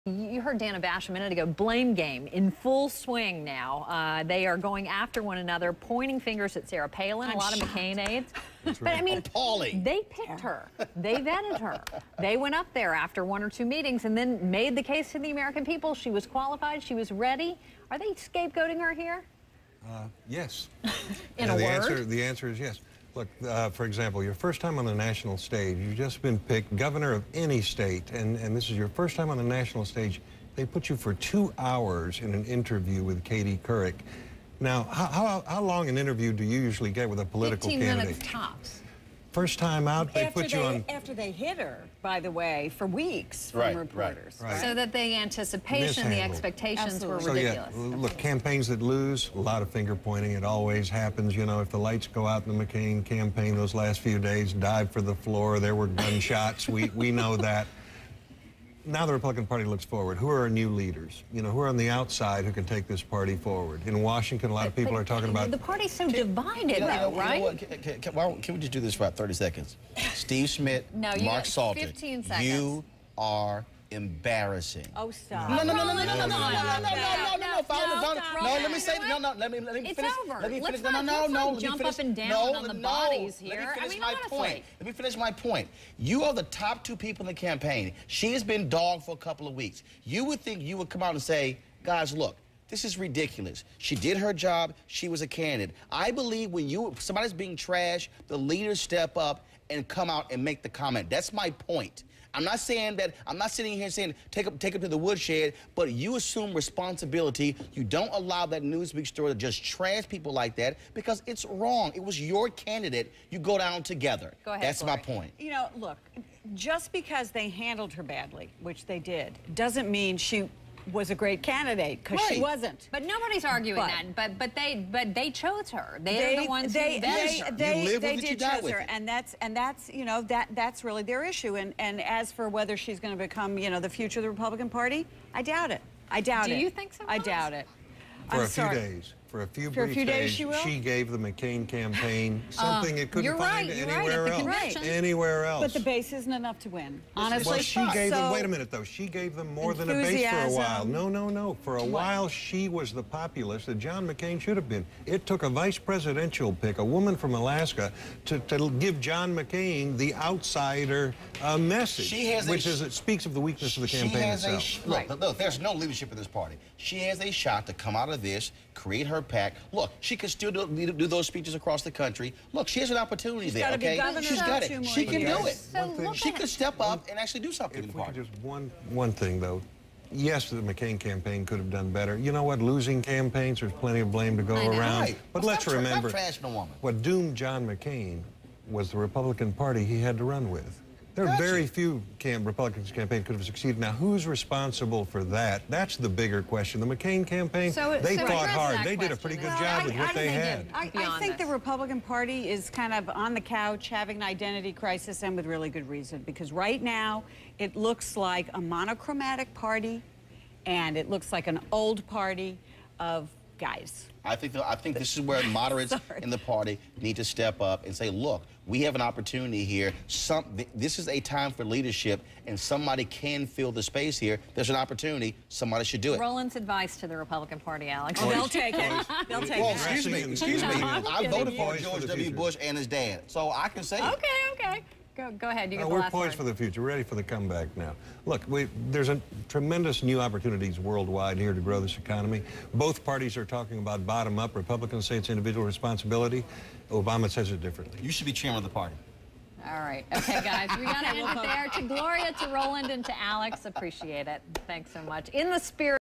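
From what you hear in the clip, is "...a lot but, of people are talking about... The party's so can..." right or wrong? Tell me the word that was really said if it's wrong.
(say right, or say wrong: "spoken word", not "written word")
right.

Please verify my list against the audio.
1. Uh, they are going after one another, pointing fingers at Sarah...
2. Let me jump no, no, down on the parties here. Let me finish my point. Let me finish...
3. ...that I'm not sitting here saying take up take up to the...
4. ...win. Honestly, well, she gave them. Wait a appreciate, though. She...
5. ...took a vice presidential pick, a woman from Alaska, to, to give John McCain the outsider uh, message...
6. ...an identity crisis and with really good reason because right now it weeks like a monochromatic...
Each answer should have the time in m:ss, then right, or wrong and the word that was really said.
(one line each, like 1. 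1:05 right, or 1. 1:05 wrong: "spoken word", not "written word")
1. 0:03 right
2. 1:21 wrong: "bodies", not "parties"
3. 1:42 right
4. 2:26 wrong: "minute", not "appreciate"
5. 2:35 right
6. 3:24 wrong: "looks", not "weeks".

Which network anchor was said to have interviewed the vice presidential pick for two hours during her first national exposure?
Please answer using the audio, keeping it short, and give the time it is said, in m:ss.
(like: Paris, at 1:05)
Katie Couric, at 0:33.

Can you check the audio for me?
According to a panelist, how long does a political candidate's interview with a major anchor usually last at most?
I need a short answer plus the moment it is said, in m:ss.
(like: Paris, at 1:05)
15 minutes, at 0:38.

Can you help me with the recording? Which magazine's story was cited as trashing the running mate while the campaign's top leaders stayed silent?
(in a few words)
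Newsweek.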